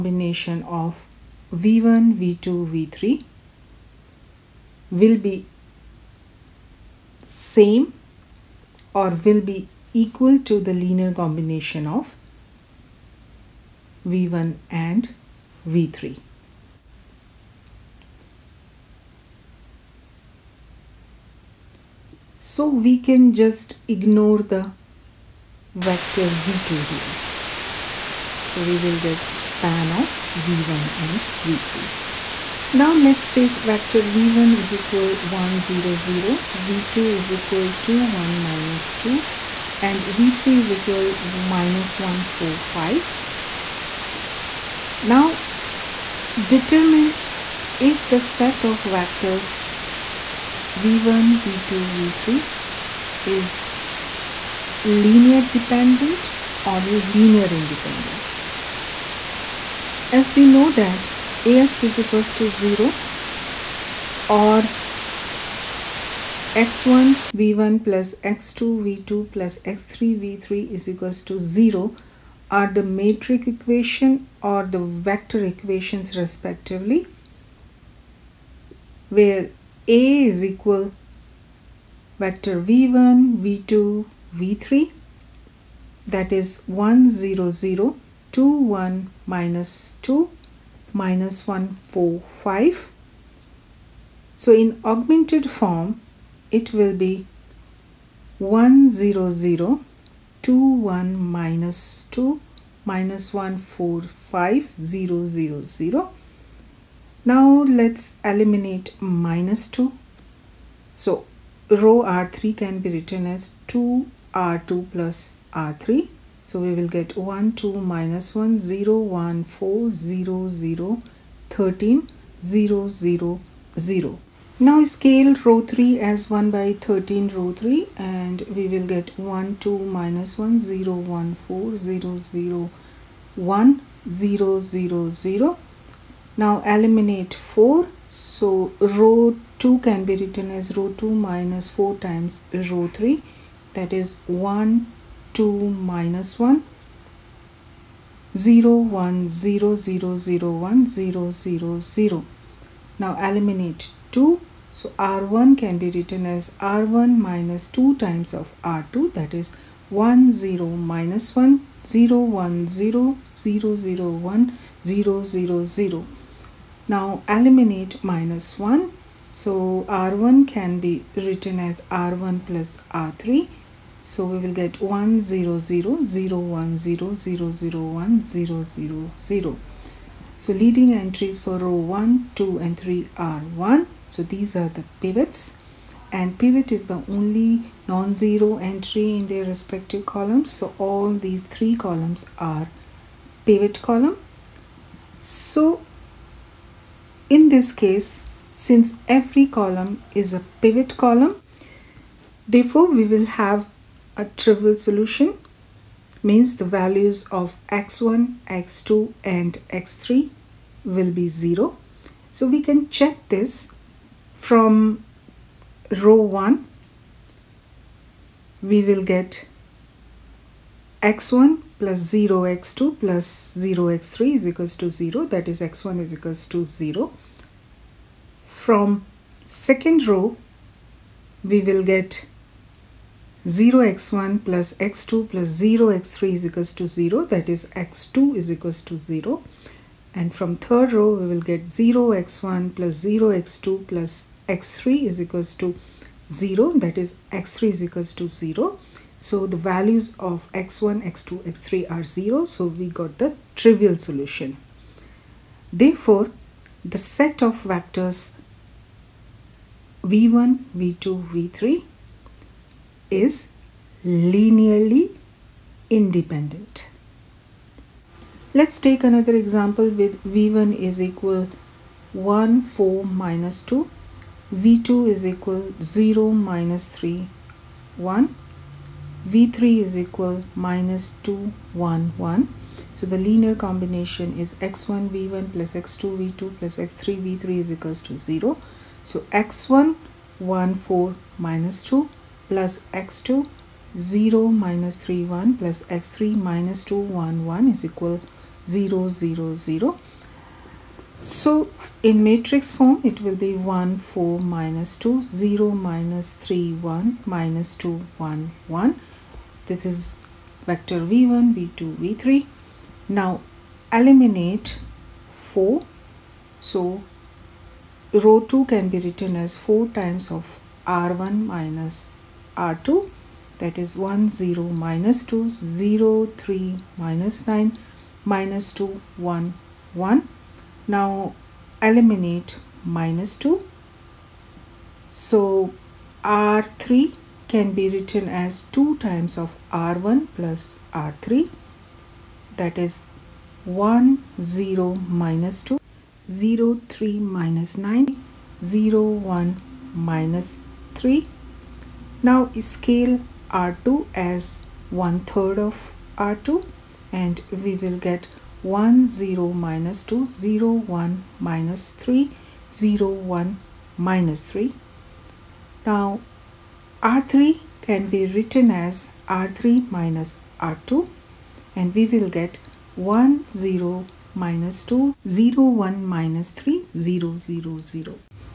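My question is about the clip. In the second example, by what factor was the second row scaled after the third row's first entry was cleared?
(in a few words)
1/3.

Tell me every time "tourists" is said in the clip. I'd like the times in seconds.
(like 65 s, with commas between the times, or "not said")
not said.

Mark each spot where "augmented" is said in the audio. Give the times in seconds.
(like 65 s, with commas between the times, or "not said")
94 s.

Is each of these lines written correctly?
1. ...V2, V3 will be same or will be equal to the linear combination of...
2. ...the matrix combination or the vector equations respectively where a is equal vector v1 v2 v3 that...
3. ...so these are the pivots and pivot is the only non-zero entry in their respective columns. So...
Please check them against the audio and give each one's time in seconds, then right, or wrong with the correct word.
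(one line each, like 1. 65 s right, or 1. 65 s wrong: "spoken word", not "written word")
1. 2 s right
2. 72 s wrong: "equation", not "combination"
3. 184 s right.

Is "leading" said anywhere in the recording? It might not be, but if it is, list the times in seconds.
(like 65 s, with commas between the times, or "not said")
180 s.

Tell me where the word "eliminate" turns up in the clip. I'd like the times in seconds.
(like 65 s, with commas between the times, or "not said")
136 s, 153 s, 167 s, 314 s, 331 s.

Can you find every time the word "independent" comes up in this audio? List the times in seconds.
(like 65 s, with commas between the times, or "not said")
57 s, 266 s.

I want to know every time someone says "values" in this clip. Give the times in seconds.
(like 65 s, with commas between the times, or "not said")
206 s, 249 s.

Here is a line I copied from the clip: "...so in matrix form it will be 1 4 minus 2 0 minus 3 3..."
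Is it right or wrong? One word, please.
wrong.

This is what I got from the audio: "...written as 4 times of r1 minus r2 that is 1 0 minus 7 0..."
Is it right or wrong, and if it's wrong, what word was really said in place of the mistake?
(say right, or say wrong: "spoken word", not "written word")
wrong: "2", not "7".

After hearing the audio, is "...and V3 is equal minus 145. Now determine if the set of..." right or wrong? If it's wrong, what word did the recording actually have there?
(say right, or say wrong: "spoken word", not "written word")
right.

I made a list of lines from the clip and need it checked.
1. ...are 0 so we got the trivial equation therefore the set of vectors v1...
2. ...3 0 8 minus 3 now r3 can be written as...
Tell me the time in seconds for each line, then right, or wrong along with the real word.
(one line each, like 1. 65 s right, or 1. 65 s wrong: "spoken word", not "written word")
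1. 251 s wrong: "solution", not "equation"
2. 361 s wrong: "1", not "8".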